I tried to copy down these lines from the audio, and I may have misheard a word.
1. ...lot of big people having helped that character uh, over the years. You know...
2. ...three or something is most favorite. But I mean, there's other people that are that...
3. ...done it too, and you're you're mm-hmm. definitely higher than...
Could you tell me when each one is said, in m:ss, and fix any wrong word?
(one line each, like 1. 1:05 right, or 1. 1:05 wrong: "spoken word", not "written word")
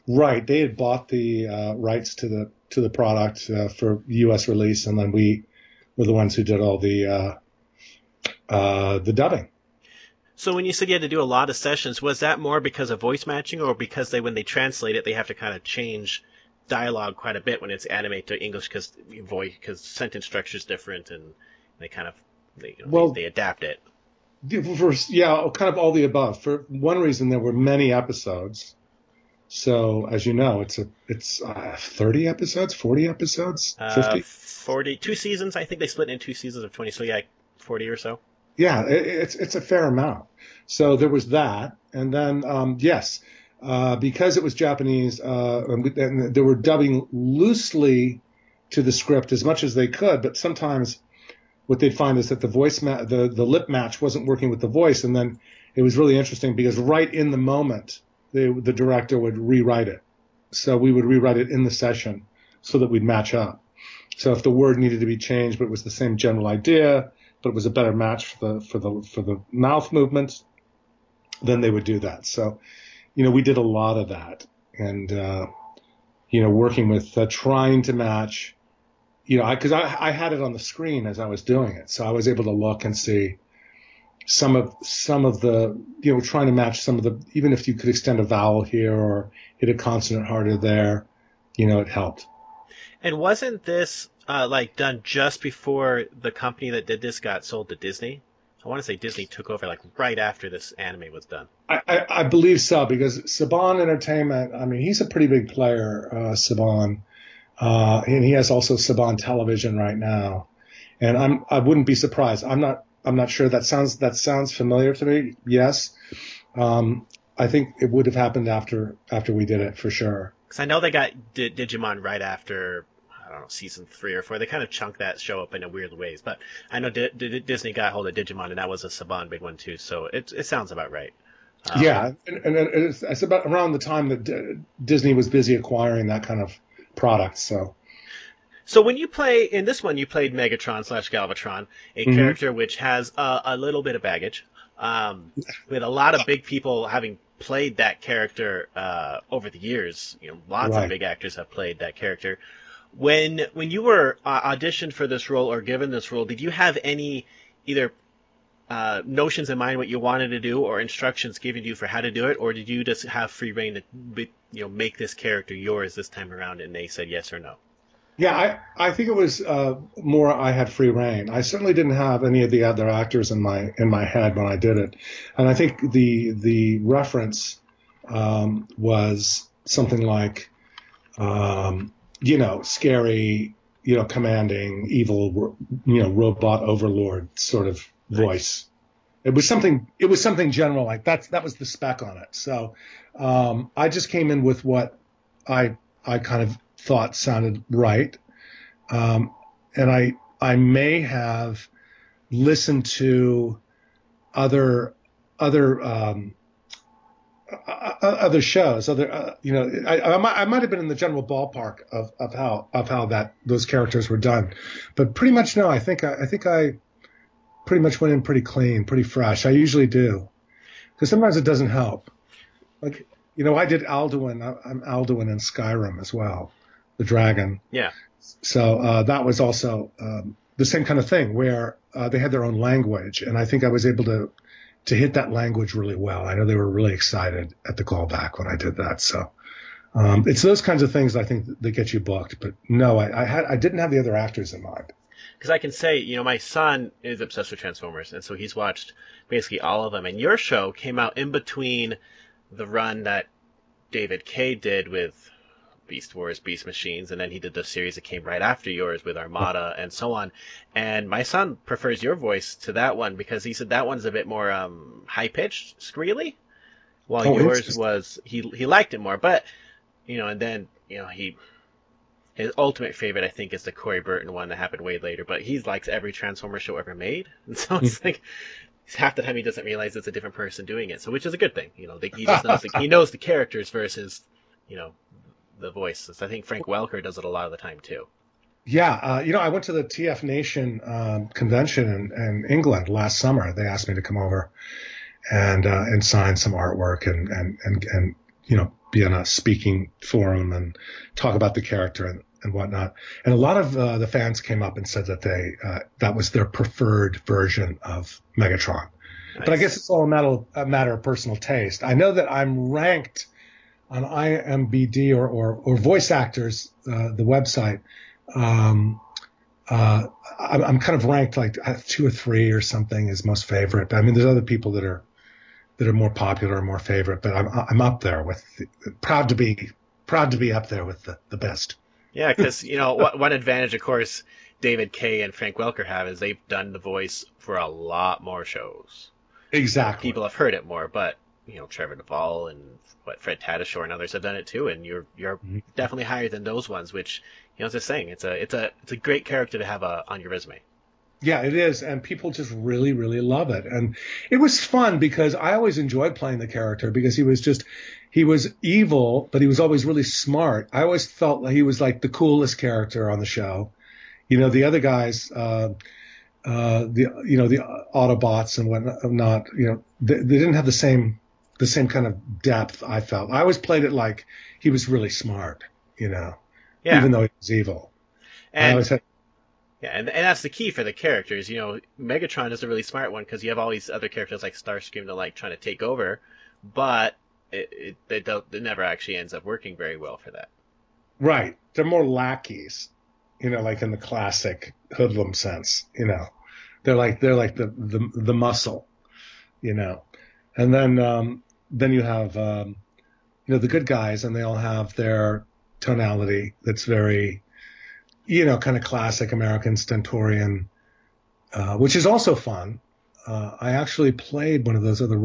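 1. 2:25 wrong: "played", not "helped"
2. 5:22 right
3. 5:44 right.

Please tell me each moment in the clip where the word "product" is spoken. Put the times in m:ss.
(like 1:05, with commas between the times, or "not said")
0:02, 2:16.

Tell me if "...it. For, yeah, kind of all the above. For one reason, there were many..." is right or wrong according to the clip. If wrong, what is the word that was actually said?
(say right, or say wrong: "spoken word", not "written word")
right.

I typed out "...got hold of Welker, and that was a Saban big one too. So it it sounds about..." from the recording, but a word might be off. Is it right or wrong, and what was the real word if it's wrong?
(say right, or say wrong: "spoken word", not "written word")
wrong: "Digimon", not "Welker".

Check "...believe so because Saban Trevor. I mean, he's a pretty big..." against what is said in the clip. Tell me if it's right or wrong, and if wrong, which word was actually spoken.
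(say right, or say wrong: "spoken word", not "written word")
wrong: "Entertainment", not "Trevor".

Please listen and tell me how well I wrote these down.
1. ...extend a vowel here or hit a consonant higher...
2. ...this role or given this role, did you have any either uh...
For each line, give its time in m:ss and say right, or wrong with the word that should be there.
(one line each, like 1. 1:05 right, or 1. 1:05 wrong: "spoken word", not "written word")
1. 1:27 wrong: "harder", not "higher"
2. 2:35 right.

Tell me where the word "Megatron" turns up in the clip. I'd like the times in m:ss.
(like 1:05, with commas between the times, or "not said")
2:20, 5:08, 6:21.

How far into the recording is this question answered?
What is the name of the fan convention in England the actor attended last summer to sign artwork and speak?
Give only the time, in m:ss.
4:49.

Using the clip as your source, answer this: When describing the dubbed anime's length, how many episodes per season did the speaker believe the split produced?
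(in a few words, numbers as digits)
20.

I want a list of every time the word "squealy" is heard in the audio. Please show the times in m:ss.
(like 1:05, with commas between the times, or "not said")
4:25.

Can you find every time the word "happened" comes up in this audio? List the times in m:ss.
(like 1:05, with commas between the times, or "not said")
1:58, 4:34.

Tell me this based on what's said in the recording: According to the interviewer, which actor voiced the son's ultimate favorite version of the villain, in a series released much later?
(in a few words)
Corey Burton.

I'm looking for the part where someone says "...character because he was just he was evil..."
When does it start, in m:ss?
5:56.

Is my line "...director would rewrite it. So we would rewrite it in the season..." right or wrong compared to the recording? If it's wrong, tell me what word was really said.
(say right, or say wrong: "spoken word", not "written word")
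wrong: "session", not "season".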